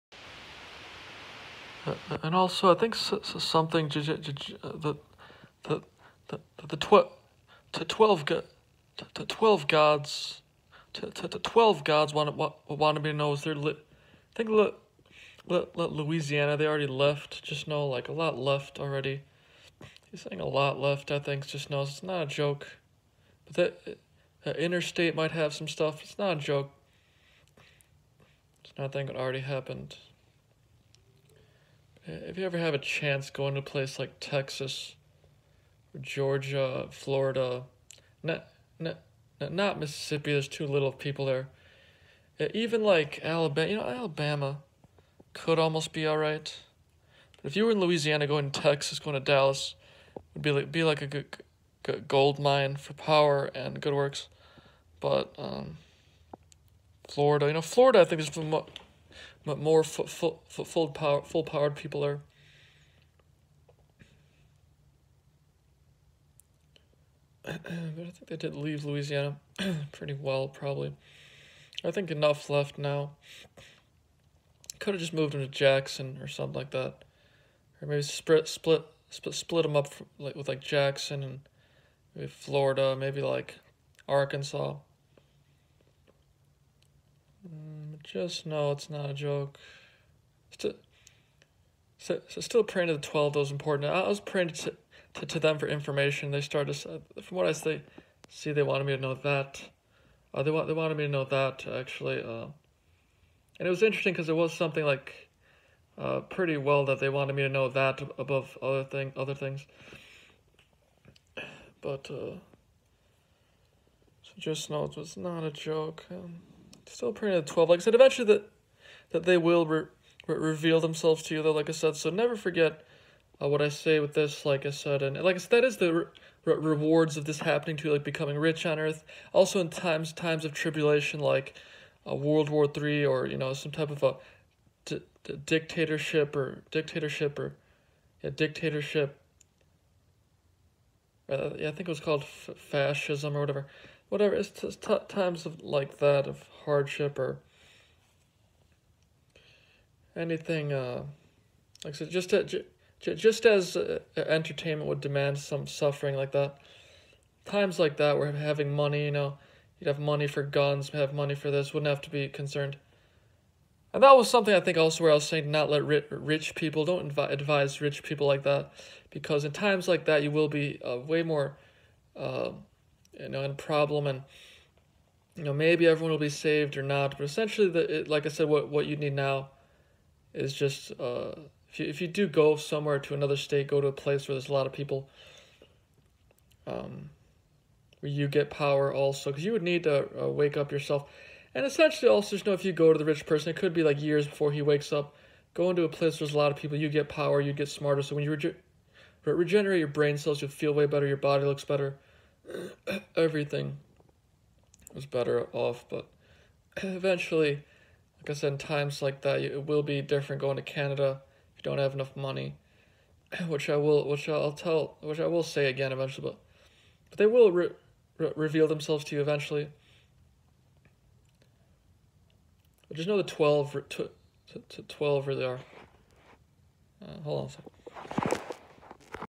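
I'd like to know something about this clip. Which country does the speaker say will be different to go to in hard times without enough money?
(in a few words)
Canada.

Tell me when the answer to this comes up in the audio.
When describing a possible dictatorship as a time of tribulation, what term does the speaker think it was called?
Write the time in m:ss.
2:22.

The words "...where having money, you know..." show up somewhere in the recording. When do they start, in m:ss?
2:38.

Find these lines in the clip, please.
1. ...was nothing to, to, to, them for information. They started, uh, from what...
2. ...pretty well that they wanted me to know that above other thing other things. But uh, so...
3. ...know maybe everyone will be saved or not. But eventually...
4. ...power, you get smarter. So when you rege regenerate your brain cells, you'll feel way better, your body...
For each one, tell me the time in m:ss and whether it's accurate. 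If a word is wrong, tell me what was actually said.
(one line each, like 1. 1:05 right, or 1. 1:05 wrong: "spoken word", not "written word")
1. 1:34 wrong: "praying", not "nothing"
2. 1:46 right
3. 2:55 wrong: "essentially", not "eventually"
4. 3:17 right.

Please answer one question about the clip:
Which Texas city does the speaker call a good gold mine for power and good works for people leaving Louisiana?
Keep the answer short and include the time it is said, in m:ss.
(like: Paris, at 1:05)
Dallas, at 0:49.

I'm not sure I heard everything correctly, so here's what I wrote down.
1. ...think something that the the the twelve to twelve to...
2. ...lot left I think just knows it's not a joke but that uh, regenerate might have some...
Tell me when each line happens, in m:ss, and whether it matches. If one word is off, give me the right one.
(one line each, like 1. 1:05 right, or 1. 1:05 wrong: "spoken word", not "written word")
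1. 0:02 right
2. 0:20 wrong: "interstate", not "regenerate".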